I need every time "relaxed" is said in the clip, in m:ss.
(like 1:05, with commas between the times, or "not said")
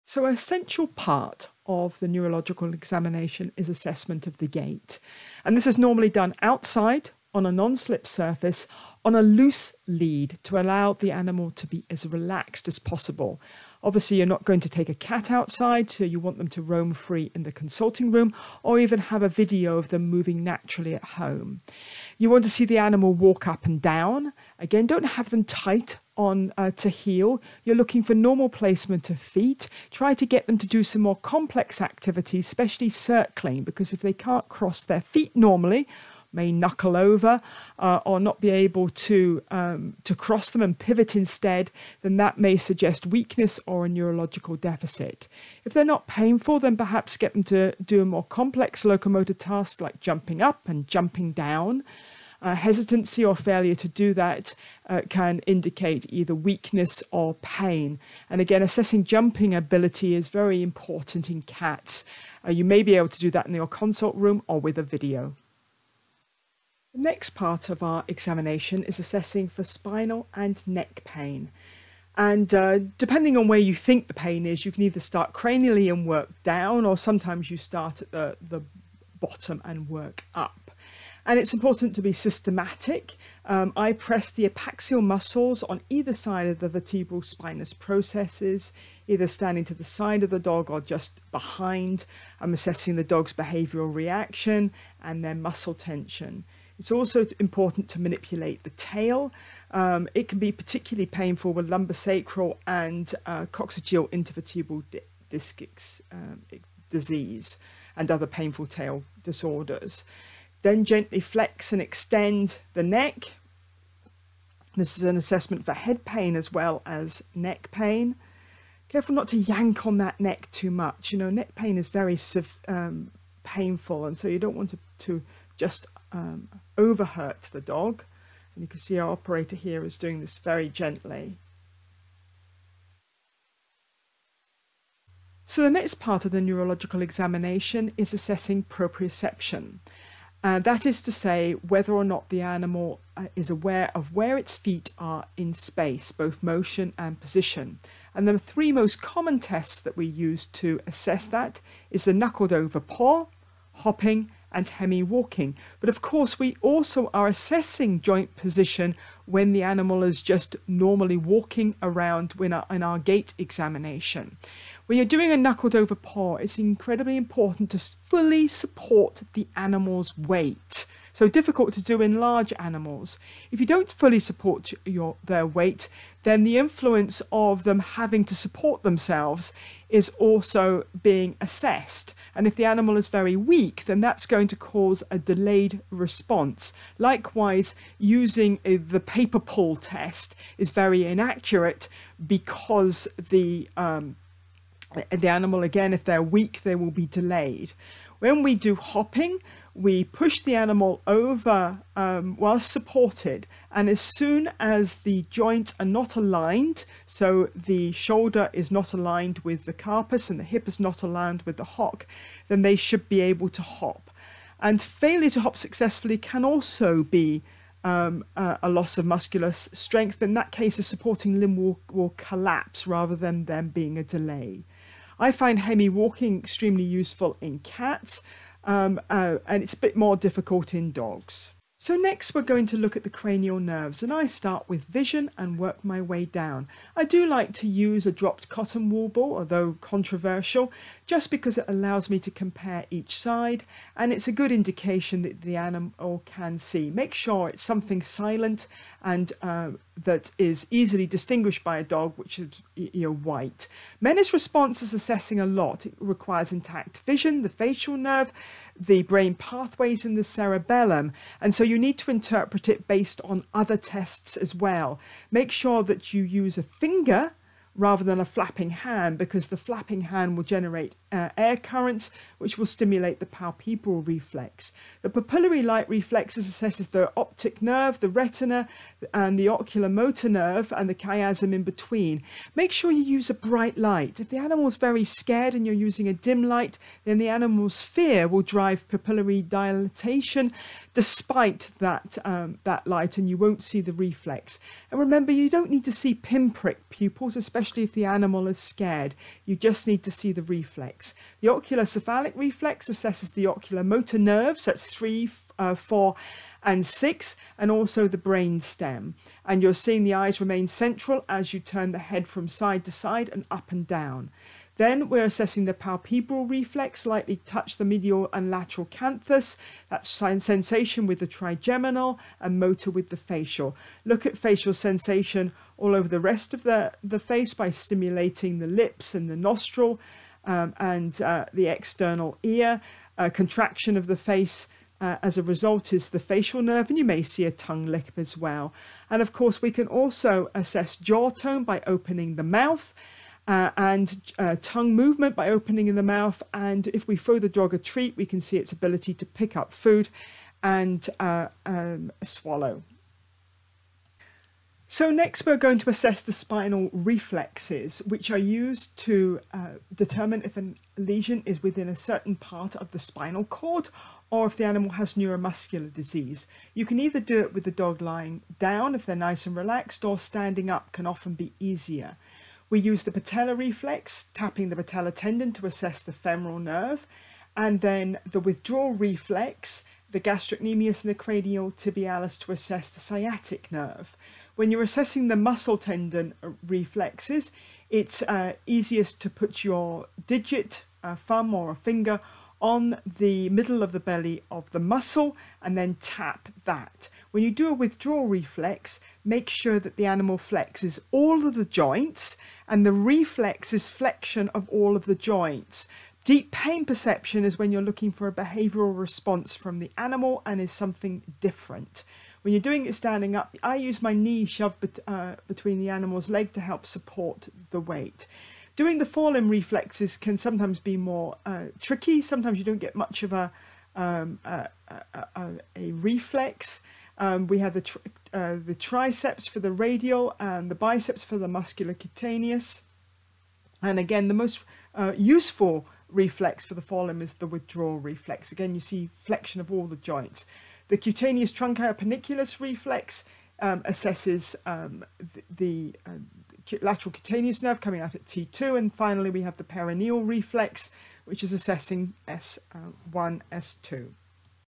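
0:12, 6:09.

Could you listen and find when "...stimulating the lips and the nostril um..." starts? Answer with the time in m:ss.
5:27.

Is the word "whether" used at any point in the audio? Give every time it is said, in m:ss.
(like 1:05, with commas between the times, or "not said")
2:21.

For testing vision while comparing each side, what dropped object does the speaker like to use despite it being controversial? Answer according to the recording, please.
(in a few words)
Cotton wool ball.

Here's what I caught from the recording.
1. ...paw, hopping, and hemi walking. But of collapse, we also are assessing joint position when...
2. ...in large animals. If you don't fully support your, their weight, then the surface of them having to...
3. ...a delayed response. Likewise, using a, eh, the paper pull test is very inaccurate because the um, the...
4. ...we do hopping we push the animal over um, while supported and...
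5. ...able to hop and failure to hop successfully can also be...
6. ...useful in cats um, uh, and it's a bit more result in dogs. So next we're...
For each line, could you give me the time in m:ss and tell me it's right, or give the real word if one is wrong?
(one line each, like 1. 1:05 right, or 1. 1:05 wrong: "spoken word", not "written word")
1. 2:32 wrong: "course", not "collapse"
2. 2:52 wrong: "influence", not "surface"
3. 3:05 right
4. 3:18 right
5. 3:33 right
6. 3:46 wrong: "difficult", not "result".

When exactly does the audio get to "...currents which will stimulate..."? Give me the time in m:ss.
4:31.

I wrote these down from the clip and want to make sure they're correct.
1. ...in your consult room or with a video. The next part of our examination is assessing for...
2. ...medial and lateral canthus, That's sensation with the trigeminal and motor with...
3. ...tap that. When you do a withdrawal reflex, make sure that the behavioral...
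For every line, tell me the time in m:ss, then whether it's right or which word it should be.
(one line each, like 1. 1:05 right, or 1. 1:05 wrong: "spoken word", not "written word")
1. 1:03 right
2. 5:17 right
3. 6:35 wrong: "animal", not "behavioral".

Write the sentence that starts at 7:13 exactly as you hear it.
And again, the most uh, useful reflex for the forelimb is the withdrawal reflex.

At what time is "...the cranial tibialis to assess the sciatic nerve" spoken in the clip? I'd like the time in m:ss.
6:21.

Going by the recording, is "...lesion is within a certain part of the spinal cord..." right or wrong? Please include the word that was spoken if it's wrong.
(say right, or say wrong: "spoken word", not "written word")
right.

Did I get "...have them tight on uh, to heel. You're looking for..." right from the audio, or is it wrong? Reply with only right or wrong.
right.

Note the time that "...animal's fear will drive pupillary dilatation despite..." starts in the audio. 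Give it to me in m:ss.
4:47.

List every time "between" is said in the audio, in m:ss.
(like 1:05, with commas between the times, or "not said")
4:41, 6:55.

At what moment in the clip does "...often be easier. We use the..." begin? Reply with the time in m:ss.
6:11.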